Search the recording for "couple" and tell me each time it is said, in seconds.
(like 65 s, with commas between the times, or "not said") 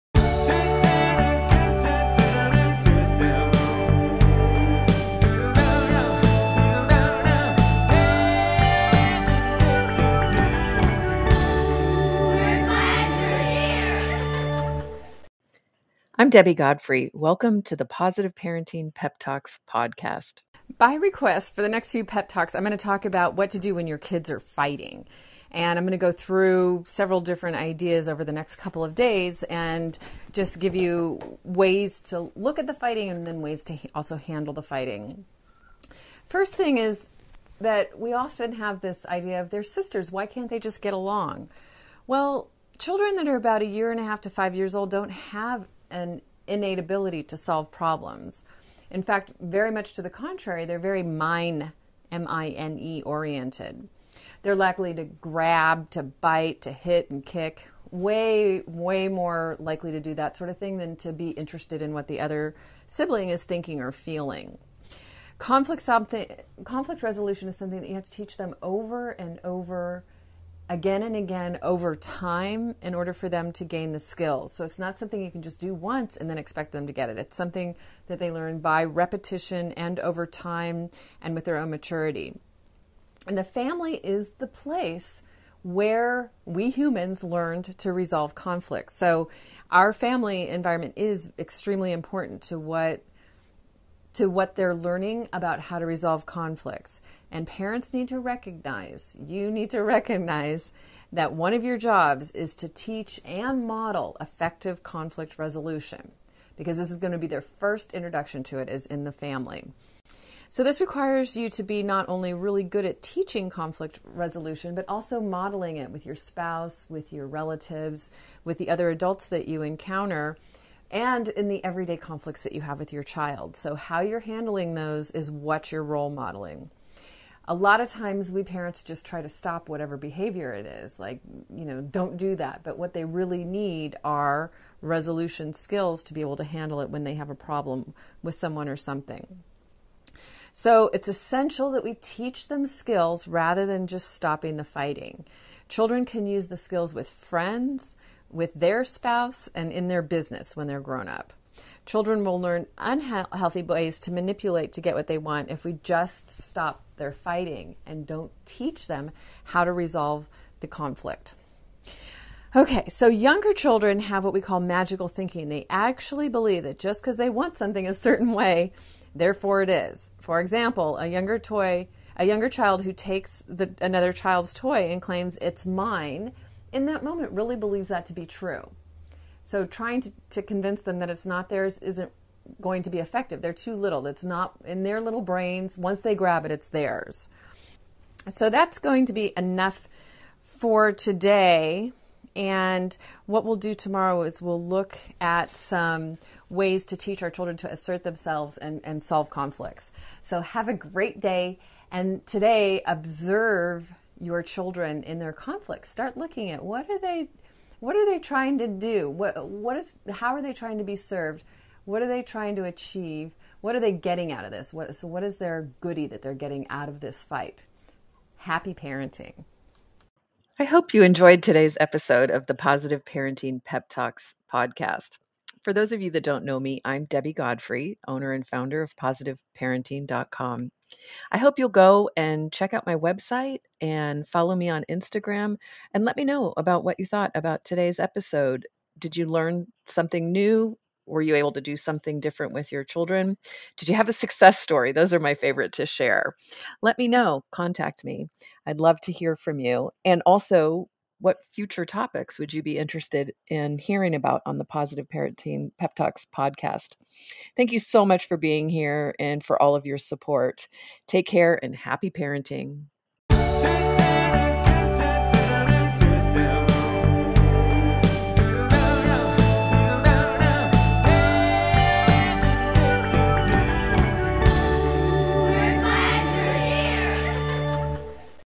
28 s.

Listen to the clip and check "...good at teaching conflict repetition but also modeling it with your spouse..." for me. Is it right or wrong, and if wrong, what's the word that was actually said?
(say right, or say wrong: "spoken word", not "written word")
wrong: "resolution", not "repetition".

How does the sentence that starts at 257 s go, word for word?
Thank you so much for being here and for all of your support.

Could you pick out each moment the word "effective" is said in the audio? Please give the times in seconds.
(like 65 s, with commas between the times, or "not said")
104 s, 182 s.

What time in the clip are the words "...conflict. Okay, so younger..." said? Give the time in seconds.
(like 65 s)
160 s.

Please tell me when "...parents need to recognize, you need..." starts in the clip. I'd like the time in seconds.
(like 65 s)
97 s.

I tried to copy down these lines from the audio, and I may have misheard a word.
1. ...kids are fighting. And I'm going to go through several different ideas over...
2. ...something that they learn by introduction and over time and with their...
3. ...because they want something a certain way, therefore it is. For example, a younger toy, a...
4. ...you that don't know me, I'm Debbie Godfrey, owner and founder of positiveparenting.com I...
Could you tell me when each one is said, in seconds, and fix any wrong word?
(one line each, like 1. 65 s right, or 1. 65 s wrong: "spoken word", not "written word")
1. 23 s right
2. 77 s wrong: "repetition", not "introduction"
3. 167 s right
4. 226 s right.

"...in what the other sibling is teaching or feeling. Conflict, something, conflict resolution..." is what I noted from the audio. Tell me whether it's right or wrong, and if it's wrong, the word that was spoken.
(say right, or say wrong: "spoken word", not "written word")
wrong: "thinking", not "teaching".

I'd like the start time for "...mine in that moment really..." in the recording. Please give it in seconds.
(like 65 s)
175 s.